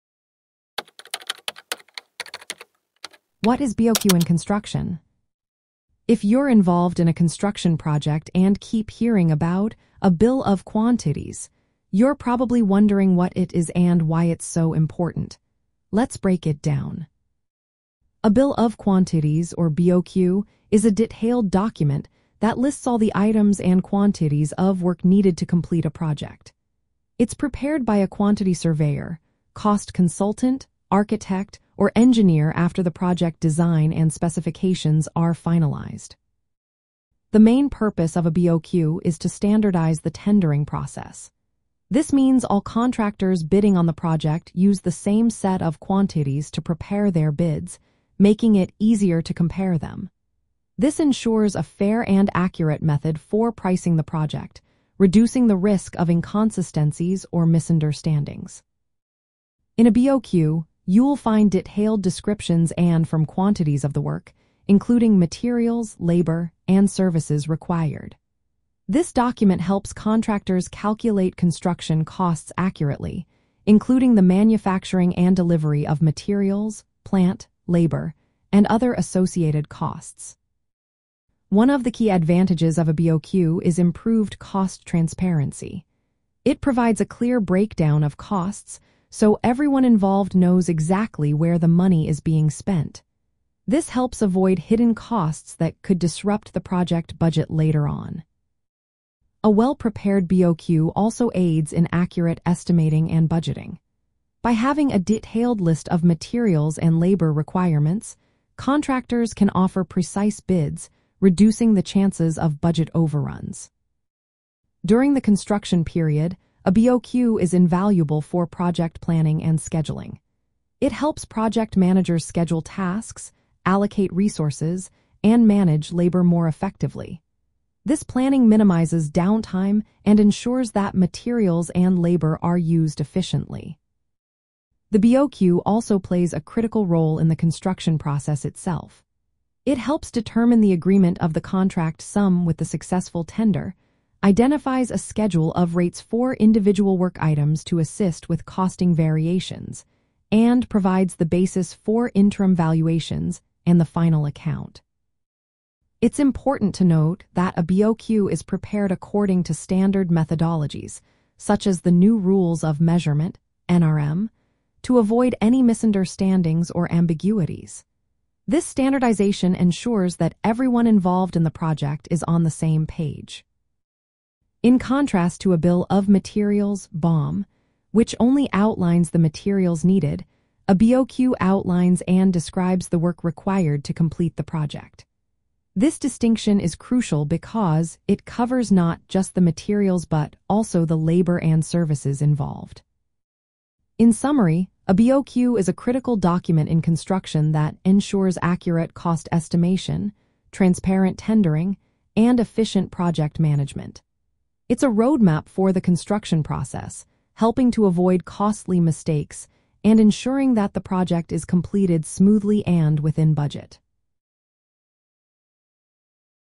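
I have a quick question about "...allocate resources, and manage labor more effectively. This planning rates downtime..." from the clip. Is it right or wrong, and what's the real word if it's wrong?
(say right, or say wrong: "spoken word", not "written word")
wrong: "minimizes", not "rates".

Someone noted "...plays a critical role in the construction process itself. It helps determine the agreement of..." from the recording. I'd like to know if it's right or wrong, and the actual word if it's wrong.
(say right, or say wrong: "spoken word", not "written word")
right.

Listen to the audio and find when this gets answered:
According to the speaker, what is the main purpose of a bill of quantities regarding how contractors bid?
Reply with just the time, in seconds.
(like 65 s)
39 s.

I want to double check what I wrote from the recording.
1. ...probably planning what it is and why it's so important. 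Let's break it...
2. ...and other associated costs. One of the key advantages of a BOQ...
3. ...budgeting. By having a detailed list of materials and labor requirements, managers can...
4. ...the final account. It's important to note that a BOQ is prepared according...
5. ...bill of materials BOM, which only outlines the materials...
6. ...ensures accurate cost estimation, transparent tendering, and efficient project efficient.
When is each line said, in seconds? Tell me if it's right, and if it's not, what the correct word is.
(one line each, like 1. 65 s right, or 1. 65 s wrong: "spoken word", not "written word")
1. 12 s wrong: "wondering", not "planning"
2. 78 s right
3. 103 s wrong: "contractors", not "managers"
4. 153 s right
5. 175 s right
6. 197 s wrong: "management", not "efficient".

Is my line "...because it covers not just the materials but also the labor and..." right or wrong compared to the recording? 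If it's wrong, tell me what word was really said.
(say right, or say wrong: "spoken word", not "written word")
right.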